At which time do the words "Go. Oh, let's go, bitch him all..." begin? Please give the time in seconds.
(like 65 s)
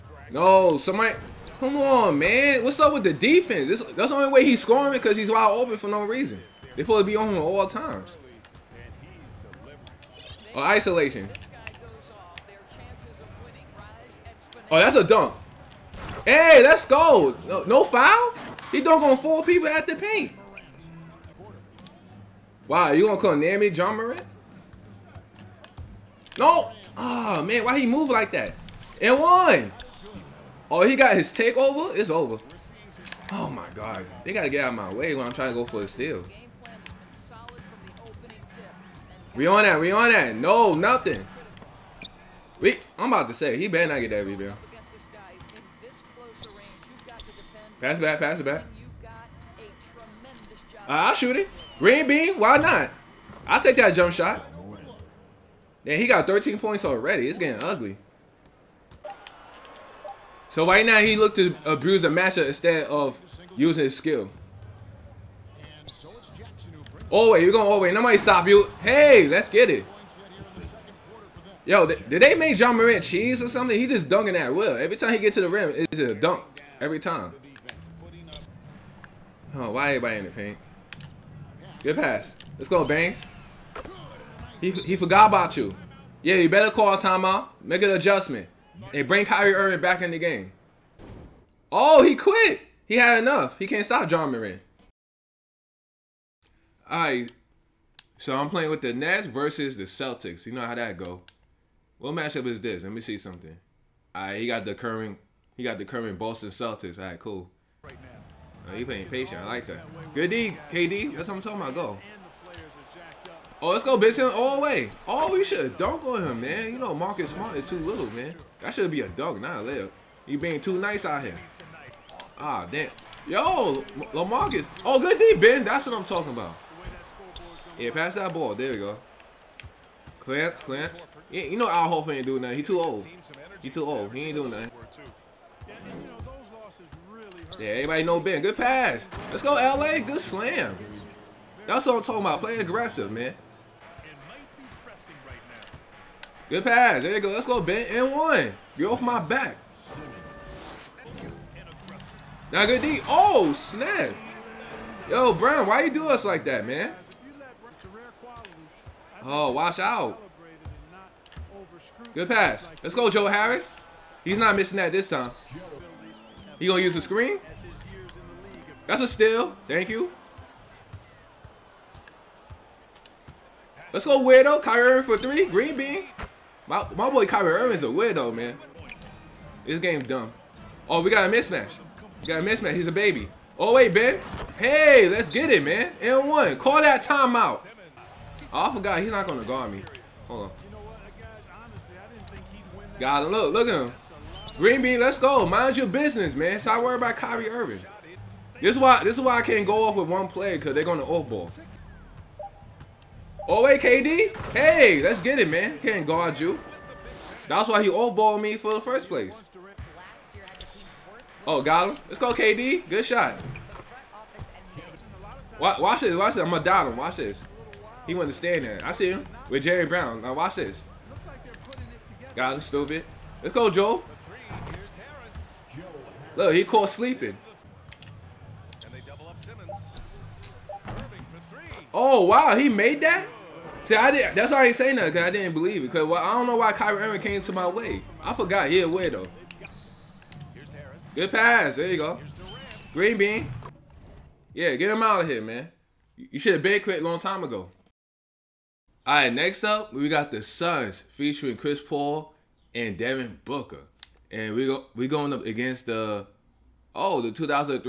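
111 s.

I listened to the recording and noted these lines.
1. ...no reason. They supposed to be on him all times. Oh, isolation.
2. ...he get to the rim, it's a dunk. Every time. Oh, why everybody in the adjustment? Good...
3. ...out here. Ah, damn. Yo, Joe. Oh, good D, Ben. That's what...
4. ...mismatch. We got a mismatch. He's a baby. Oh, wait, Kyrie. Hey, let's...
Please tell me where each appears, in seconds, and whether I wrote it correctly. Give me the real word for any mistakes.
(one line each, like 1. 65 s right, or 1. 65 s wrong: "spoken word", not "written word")
1. 5 s right
2. 75 s wrong: "paint", not "adjustment"
3. 121 s wrong: "LaMarcus", not "Joe"
4. 181 s wrong: "Ben", not "Kyrie".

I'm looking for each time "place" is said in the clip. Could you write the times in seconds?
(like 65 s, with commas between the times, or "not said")
209 s.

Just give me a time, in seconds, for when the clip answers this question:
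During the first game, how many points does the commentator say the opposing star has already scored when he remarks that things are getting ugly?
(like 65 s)
56 s.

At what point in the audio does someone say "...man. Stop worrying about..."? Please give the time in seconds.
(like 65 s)
196 s.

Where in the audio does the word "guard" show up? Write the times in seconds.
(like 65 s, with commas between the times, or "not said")
189 s, 206 s.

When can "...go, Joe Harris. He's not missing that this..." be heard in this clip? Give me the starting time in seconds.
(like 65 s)
162 s.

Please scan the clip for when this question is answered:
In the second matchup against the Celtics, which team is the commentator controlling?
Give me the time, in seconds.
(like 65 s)
98 s.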